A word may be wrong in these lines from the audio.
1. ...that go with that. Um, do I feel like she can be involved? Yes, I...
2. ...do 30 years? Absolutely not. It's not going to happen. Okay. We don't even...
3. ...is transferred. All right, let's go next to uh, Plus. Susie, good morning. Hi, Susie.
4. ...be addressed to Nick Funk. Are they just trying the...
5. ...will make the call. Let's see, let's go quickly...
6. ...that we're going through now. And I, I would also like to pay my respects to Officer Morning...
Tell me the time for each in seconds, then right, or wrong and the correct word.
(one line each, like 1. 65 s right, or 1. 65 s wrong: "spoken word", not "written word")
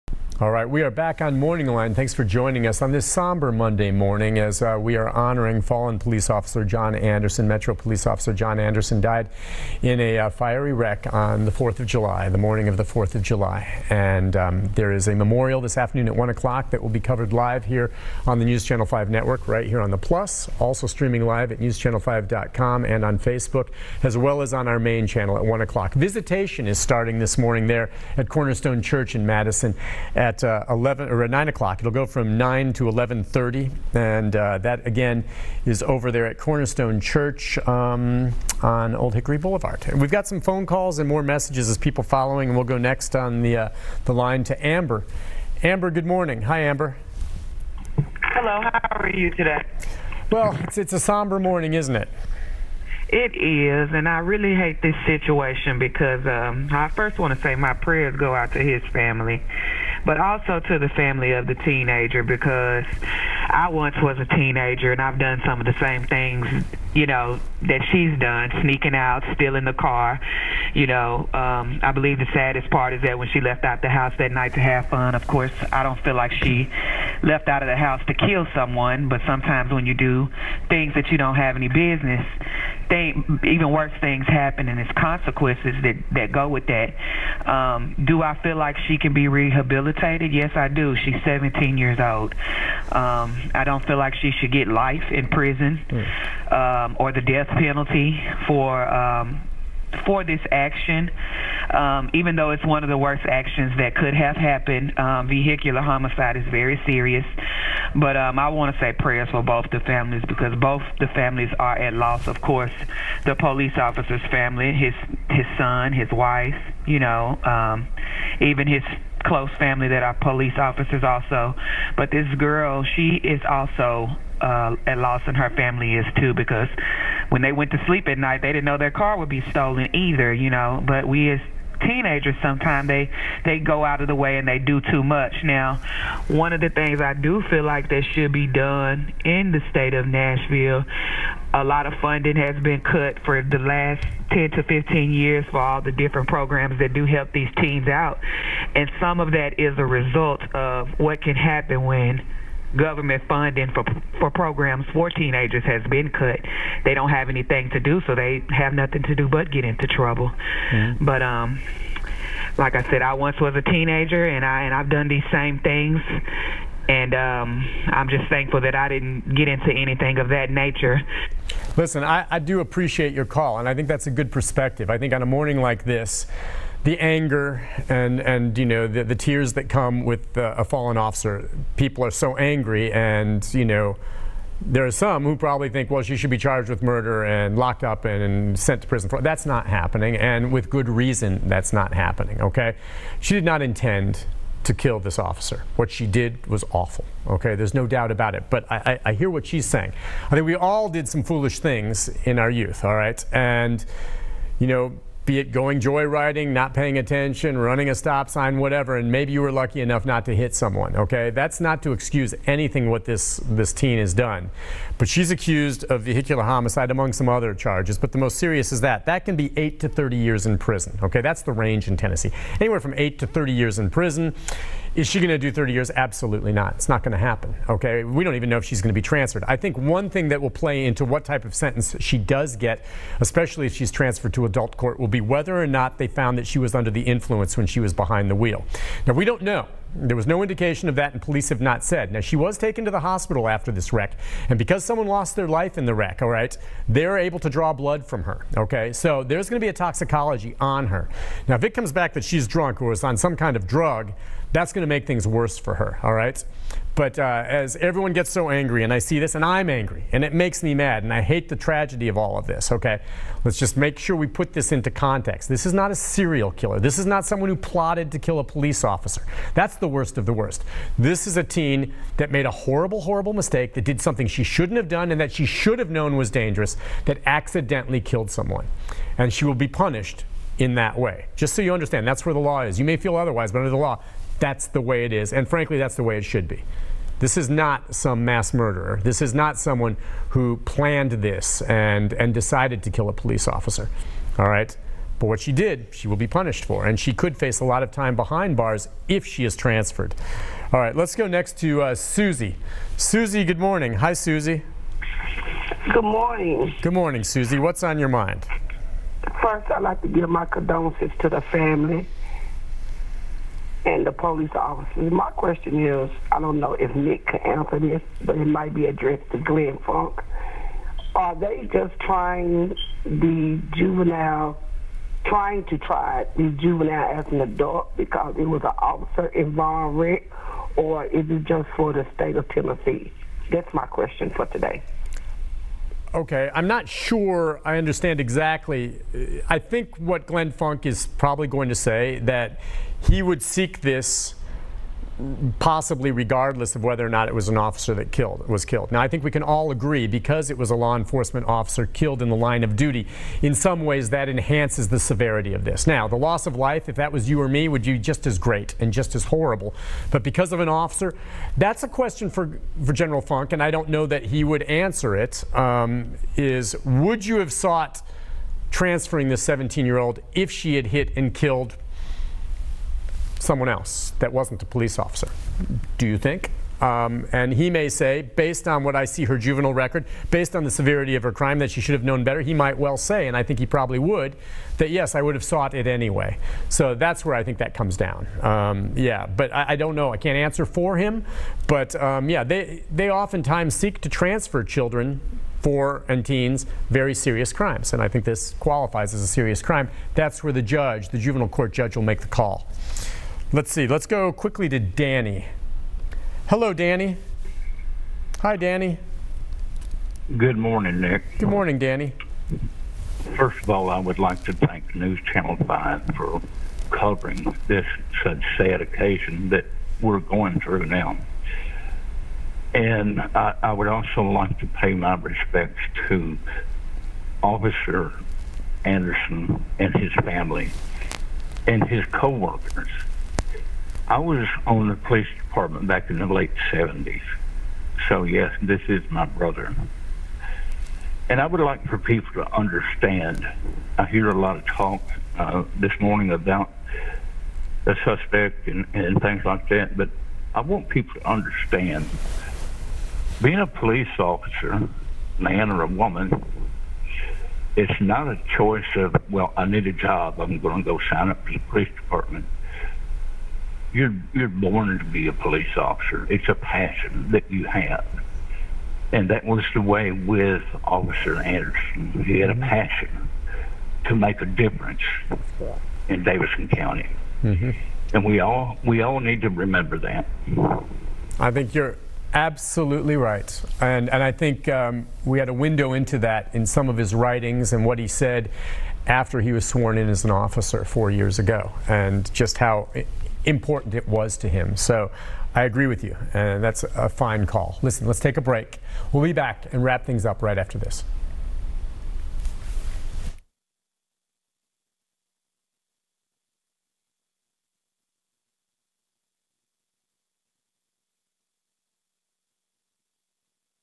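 1. 86 s wrong: "rehabilitated", not "involved"
2. 225 s right
3. 299 s wrong: "Susie", not "Plus"
4. 318 s wrong: "Glenn", not "Nick"
5. 401 s right
6. 419 s wrong: "Anderson", not "Morning".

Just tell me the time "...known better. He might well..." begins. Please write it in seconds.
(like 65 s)
382 s.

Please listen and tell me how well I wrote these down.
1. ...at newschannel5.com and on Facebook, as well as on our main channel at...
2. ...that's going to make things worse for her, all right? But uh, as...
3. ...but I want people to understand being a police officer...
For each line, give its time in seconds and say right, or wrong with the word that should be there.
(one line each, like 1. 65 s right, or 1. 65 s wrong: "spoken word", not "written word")
1. 21 s right
2. 254 s right
3. 449 s right.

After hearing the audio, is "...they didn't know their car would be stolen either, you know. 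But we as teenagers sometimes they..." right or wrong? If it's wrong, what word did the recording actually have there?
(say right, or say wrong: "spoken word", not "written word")
right.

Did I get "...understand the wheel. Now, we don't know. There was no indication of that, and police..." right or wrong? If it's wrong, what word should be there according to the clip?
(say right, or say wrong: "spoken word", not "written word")
wrong: "behind", not "understand".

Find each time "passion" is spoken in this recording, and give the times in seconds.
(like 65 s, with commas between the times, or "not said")
466 s, 472 s.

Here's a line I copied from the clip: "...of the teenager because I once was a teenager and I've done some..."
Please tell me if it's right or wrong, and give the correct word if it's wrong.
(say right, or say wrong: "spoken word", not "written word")
right.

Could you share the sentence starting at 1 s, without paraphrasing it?
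Thanks for joining us on this somber Monday morning as uh, we are honoring fallen police officer John Anderson.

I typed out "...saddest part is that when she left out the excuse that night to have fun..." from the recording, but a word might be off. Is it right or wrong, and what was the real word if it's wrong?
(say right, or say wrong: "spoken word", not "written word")
wrong: "house", not "excuse".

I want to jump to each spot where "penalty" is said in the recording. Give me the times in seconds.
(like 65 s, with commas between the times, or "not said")
97 s.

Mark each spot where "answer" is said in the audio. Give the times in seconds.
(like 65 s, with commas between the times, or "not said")
317 s, 364 s, 390 s.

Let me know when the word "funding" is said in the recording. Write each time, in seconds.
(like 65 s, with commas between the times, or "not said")
141 s, 153 s.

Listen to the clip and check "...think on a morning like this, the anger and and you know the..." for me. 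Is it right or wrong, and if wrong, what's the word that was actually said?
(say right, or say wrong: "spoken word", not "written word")
right.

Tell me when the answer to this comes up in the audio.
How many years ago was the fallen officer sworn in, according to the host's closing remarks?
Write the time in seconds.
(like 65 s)
490 s.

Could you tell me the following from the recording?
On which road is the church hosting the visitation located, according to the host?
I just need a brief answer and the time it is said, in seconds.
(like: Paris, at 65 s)
Old Hickory Boulevard, at 38 s.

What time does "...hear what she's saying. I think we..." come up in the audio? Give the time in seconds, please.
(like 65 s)
199 s.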